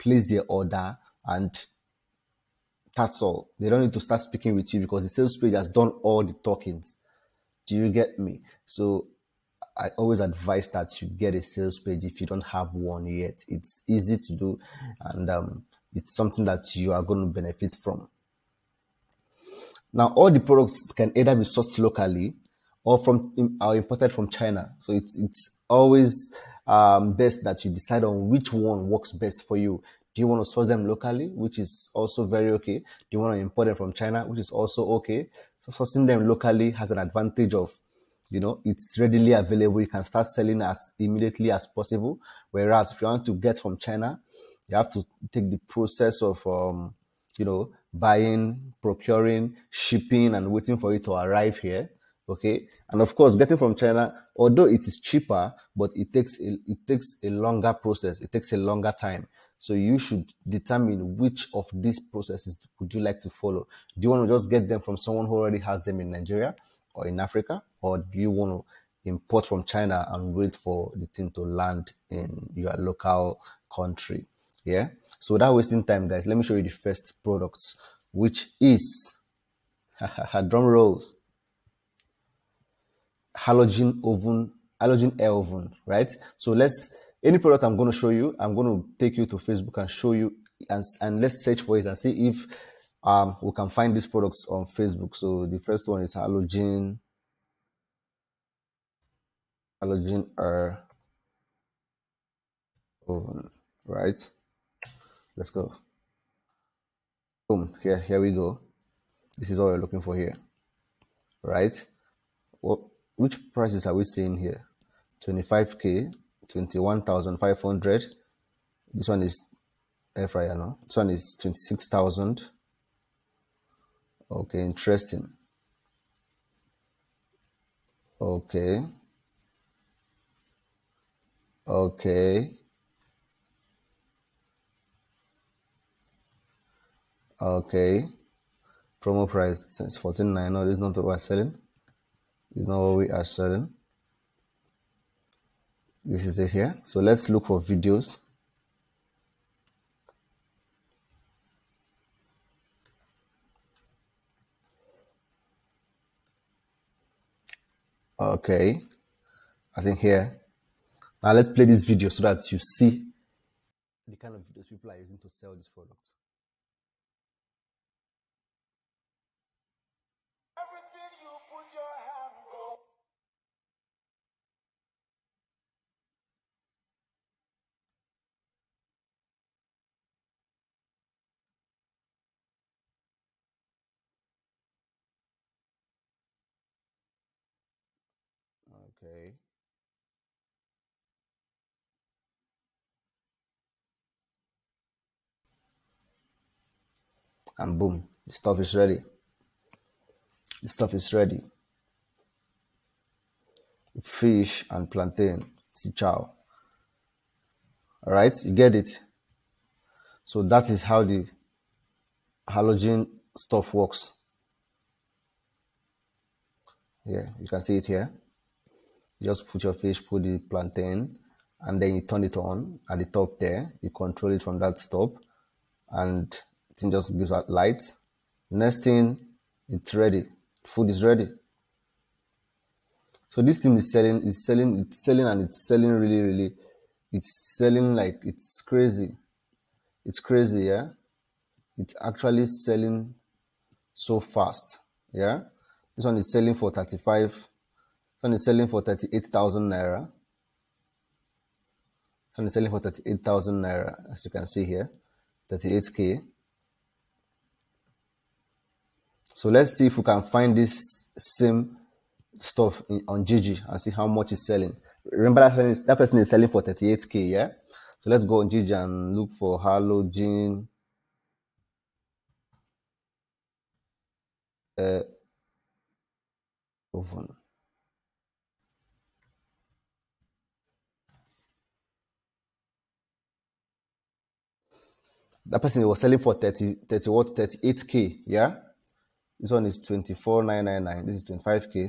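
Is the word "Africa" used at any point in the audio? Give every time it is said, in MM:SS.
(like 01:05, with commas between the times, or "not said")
01:07.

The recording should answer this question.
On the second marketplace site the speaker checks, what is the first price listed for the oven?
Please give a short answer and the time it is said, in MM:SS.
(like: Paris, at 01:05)
24,999, at 04:49.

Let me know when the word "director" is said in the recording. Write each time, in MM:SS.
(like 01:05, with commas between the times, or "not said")
not said.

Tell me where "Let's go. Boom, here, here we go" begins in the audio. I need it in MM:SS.
01:45.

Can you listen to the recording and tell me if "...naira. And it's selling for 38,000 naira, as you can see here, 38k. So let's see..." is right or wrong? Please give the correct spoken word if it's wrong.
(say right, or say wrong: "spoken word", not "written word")
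right.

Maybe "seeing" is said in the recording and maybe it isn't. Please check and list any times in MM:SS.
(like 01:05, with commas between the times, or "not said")
01:54.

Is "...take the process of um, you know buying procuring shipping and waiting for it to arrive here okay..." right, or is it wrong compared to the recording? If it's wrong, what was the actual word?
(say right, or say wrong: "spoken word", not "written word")
right.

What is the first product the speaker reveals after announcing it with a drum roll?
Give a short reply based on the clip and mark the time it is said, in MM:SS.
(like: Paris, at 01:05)
Halogen oven, at 01:23.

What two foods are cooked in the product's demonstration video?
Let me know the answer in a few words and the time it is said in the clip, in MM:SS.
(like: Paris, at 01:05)
Fish and plantain, at 03:24.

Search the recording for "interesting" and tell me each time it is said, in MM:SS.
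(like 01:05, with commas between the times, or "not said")
02:04.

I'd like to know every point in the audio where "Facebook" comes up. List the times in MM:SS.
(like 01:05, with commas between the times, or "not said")
01:29, 01:34.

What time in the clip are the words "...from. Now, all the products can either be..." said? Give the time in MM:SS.
00:17.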